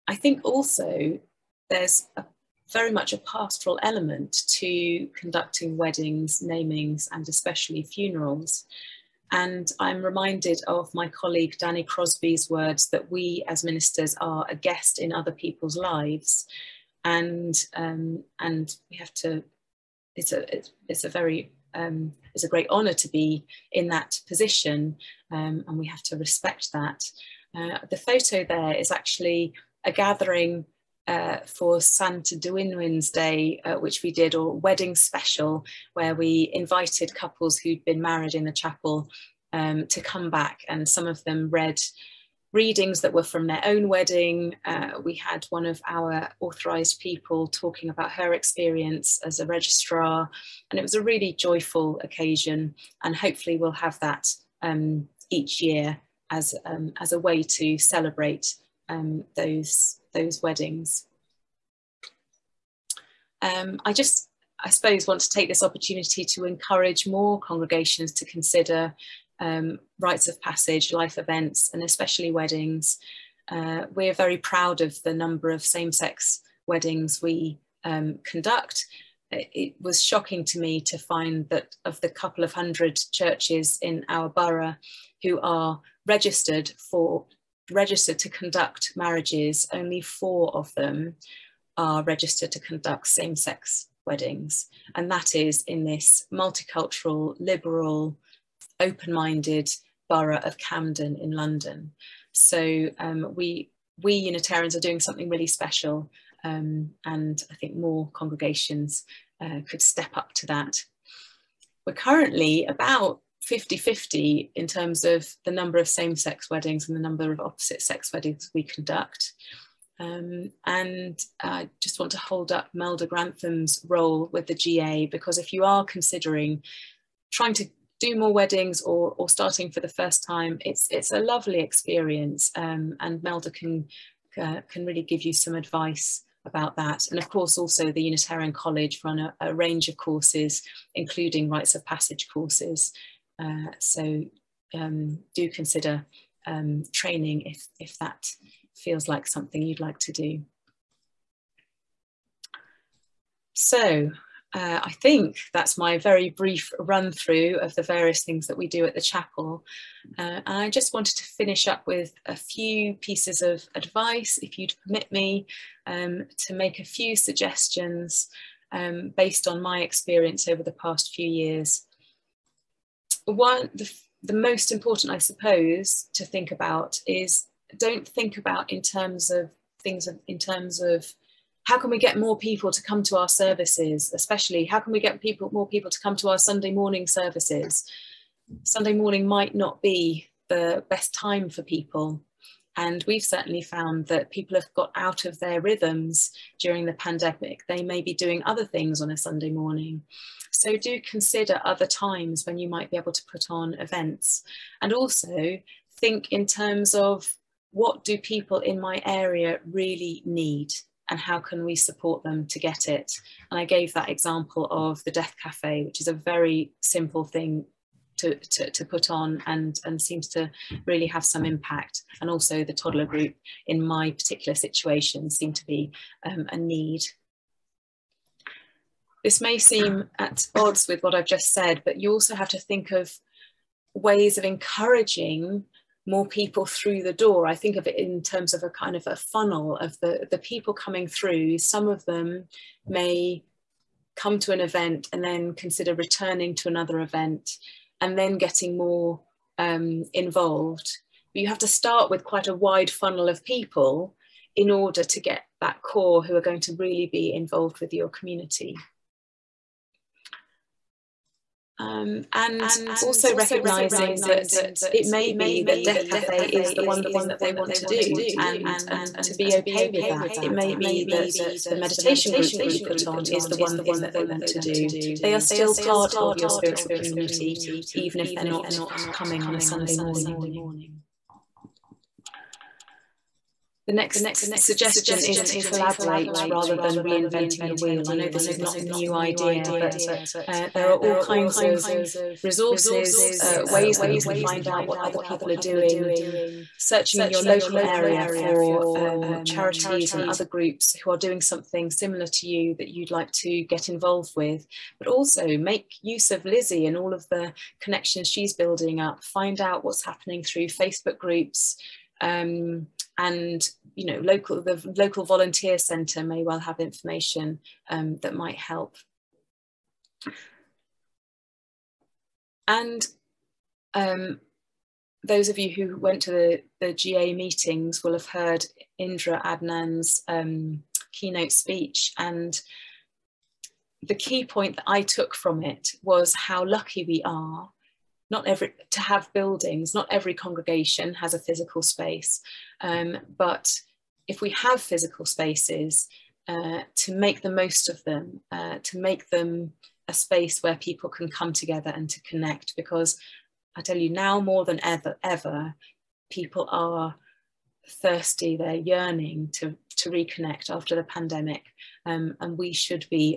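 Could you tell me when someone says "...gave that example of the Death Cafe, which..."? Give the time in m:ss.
3:33.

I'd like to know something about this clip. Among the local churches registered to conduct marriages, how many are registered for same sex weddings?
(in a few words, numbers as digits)
4.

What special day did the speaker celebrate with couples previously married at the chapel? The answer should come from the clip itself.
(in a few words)
Santes Dwynwen's Day.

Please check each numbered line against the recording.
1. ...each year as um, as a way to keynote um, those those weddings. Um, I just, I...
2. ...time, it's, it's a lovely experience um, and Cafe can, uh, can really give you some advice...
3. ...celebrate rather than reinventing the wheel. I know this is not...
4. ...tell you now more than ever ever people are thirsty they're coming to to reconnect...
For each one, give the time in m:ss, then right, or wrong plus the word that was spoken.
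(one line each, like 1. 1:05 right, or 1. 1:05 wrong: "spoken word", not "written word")
1. 0:55 wrong: "celebrate", not "keynote"
2. 2:10 wrong: "Melda", not "Cafe"
3. 4:45 wrong: "collaborate", not "celebrate"
4. 5:53 wrong: "yearning", not "coming".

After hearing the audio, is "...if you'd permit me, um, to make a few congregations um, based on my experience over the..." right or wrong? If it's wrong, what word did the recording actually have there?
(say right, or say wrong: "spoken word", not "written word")
wrong: "suggestions", not "congregations".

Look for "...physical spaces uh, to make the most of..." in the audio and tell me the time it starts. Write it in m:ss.
5:44.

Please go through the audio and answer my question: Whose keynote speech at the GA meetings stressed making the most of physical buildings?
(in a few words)
Indra Adnan.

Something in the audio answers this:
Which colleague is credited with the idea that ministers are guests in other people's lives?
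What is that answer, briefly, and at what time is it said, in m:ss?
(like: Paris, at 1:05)
Danny Crosby, at 0:11.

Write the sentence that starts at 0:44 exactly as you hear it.
Uh, we had one of our authorised people talking about her experience as a registrar, and it was a really joyful occasion.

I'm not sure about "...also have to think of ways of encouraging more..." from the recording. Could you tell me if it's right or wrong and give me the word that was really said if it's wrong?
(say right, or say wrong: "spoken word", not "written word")
right.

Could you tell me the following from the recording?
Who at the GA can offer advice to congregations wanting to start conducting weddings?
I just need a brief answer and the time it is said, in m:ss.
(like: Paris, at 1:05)
Melda Grantham, at 2:02.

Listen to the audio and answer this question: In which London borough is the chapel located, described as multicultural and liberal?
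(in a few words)
Camden.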